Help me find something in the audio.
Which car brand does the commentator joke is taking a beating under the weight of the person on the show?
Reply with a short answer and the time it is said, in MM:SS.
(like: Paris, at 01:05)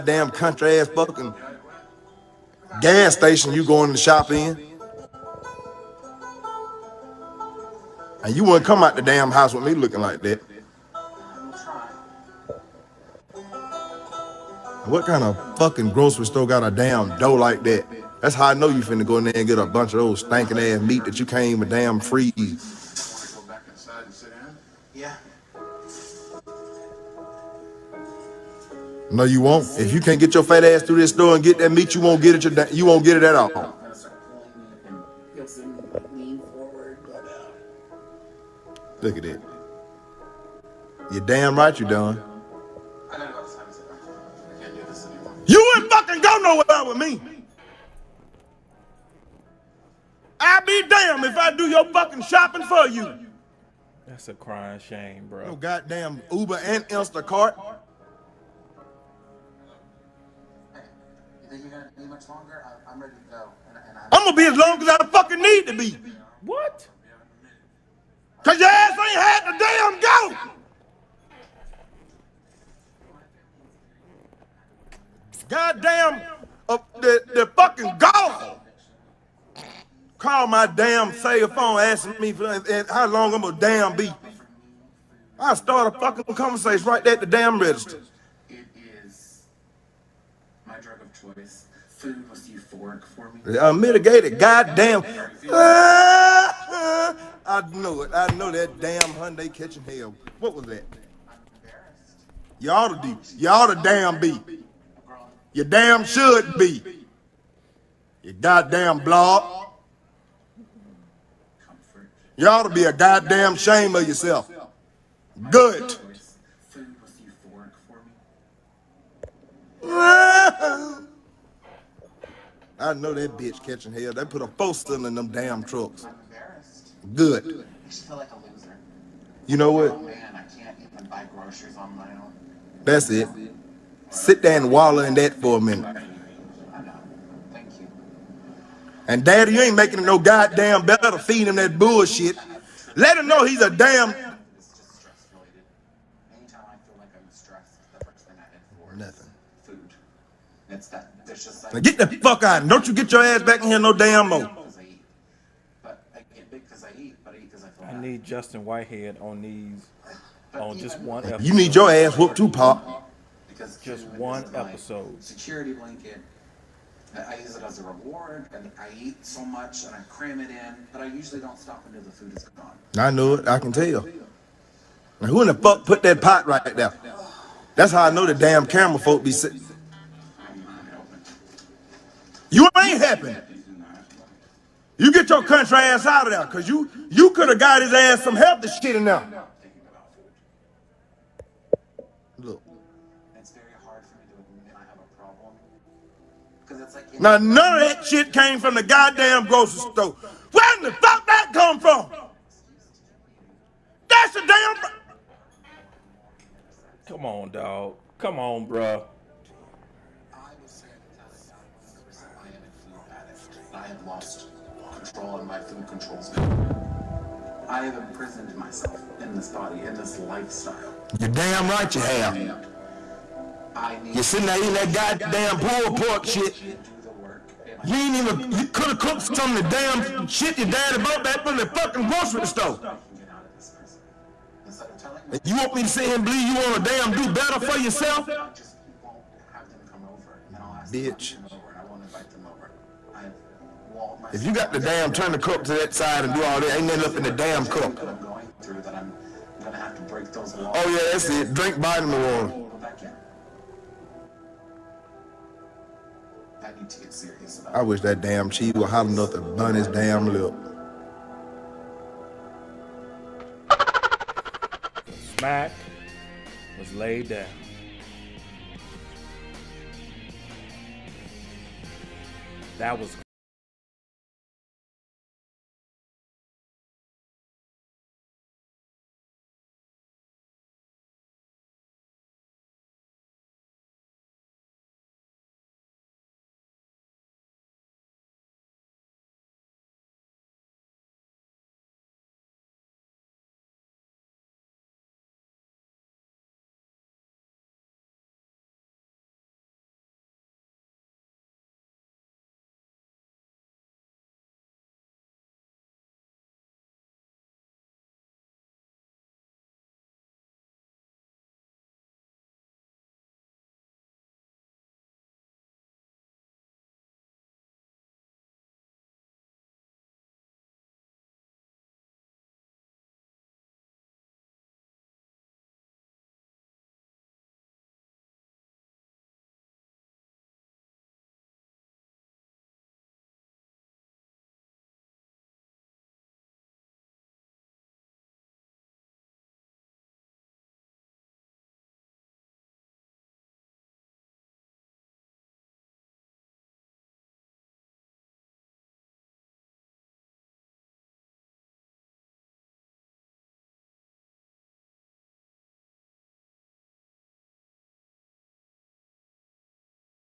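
Hyundai, at 01:39.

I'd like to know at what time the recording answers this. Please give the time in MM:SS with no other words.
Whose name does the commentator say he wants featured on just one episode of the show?
02:38.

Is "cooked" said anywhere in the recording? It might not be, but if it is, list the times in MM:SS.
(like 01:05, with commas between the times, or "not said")
03:48.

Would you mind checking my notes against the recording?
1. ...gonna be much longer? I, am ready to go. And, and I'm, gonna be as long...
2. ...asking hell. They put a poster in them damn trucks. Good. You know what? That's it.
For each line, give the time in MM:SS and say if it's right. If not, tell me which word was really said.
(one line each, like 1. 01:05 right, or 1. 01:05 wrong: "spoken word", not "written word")
1. 01:01 right
2. 02:03 wrong: "catching", not "asking".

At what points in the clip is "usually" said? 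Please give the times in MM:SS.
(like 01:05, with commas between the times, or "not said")
02:51.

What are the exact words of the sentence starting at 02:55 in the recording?
Now, who in the fuck put that pot right there?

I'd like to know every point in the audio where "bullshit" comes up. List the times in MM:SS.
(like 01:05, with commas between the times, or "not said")
02:21.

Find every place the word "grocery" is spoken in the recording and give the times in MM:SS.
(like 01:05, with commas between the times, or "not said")
00:15, 03:19, 03:52.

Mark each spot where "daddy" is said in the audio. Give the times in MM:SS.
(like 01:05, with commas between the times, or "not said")
02:19, 03:50.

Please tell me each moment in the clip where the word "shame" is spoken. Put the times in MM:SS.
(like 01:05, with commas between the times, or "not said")
00:54, 01:53.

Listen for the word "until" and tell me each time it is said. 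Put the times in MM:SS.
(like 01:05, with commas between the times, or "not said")
02:51.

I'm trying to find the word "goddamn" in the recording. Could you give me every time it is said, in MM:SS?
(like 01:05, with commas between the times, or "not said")
00:55, 01:15, 01:34, 01:48, 01:52, 02:20, 03:18, 03:44.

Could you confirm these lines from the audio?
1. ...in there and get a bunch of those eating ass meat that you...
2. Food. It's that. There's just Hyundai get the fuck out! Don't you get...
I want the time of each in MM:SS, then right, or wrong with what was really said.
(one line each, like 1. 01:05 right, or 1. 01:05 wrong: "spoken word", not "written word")
1. 00:19 wrong: "stinking", not "eating"
2. 02:29 wrong: "Now", not "Hyundai".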